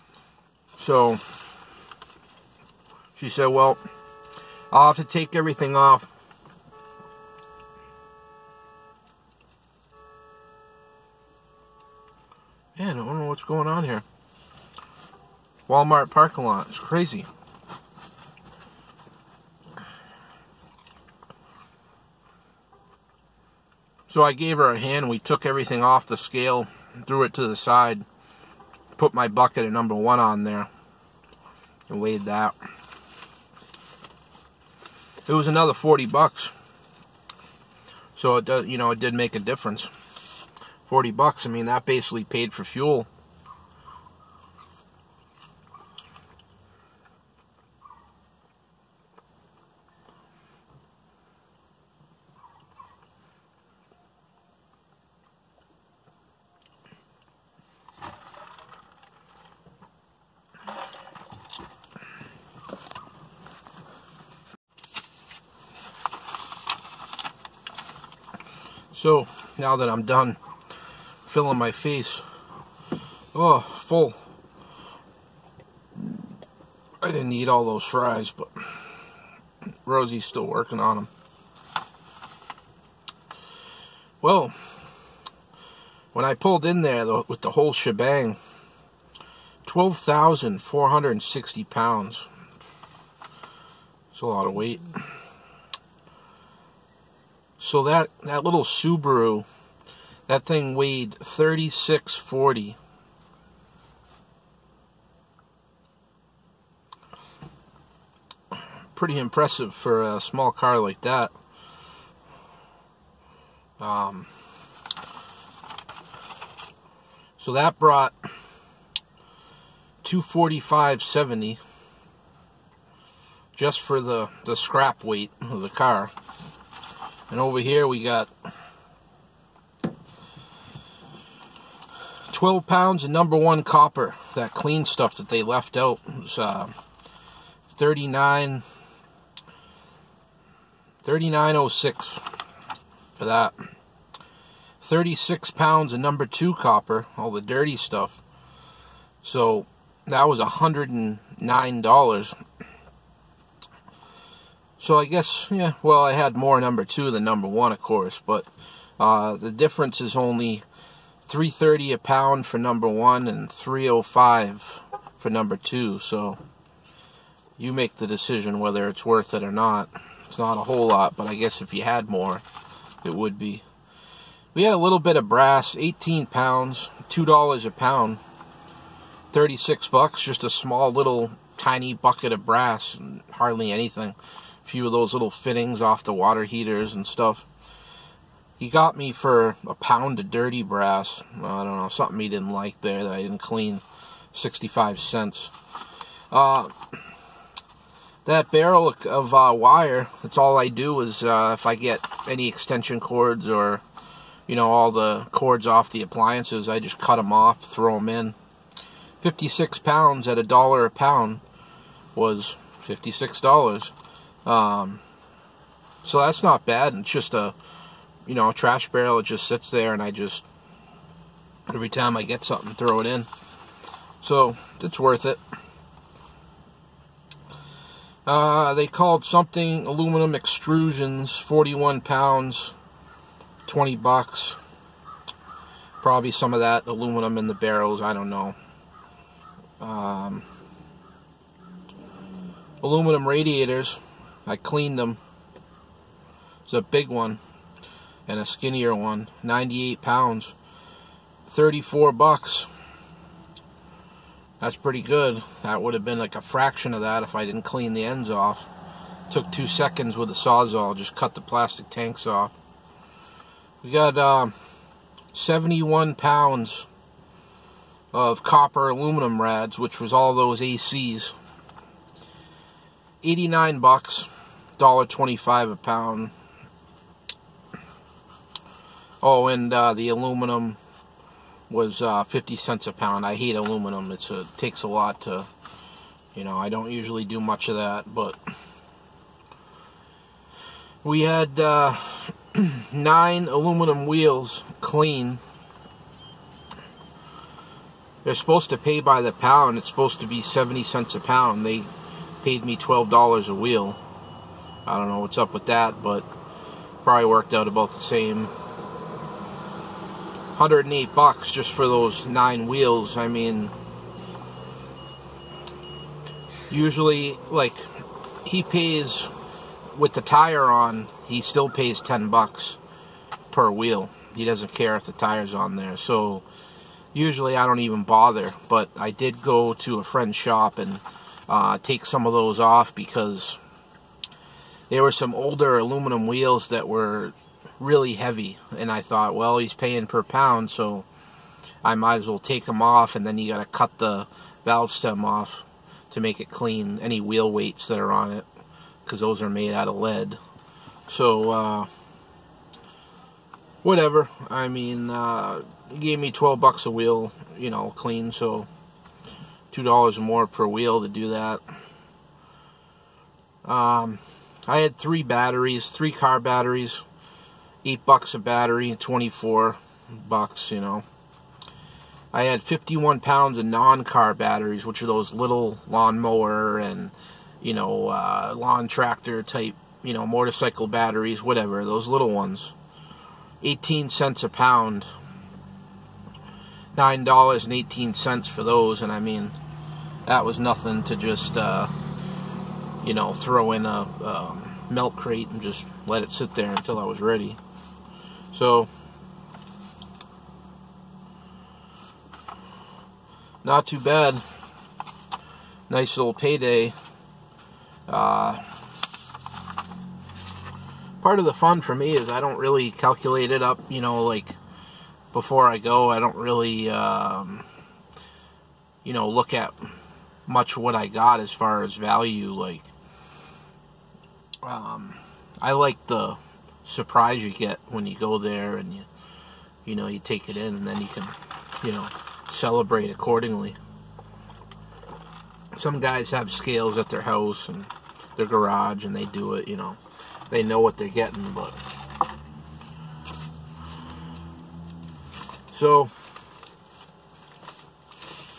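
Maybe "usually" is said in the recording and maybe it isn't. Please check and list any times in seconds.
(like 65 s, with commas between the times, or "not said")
286 s, 316 s, 327 s.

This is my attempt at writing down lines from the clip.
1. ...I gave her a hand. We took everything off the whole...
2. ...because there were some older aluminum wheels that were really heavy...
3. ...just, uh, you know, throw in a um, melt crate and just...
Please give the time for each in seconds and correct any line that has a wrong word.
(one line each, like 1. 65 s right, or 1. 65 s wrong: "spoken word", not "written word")
1. 24 s wrong: "scale", not "whole"
2. 332 s right
3. 391 s right.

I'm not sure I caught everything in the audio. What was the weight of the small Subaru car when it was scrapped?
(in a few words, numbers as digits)
3640.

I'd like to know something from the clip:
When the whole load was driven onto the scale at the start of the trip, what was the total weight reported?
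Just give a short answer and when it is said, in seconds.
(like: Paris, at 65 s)
12,460 pounds, at 89 s.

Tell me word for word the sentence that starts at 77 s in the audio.
I didn't eat all those fries, but Rosie's still working on them.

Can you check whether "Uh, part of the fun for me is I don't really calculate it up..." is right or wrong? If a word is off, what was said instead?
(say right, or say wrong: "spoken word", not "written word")
right.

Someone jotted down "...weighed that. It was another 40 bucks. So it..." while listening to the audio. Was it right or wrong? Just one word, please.
right.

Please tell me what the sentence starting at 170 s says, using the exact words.
It's not a whole lot, but I guess if you had more, it would be.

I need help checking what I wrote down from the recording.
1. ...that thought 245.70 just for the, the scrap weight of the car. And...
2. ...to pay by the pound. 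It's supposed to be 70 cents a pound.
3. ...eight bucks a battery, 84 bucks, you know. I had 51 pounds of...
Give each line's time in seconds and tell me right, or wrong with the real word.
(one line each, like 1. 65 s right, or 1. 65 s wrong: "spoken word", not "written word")
1. 117 s wrong: "brought", not "thought"
2. 298 s right
3. 367 s wrong: "24", not "84".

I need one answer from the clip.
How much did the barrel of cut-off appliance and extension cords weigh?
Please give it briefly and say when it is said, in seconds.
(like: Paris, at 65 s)
56 pounds, at 209 s.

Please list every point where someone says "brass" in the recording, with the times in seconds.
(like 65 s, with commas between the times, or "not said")
175 s, 182 s, 190 s.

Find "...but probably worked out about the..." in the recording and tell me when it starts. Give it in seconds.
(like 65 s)
306 s.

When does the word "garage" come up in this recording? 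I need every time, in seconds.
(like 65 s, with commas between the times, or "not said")
438 s.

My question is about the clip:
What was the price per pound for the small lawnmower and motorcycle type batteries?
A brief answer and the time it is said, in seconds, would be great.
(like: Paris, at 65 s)
18 cents, at 383 s.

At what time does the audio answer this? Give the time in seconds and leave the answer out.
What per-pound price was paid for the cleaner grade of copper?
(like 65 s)
161 s.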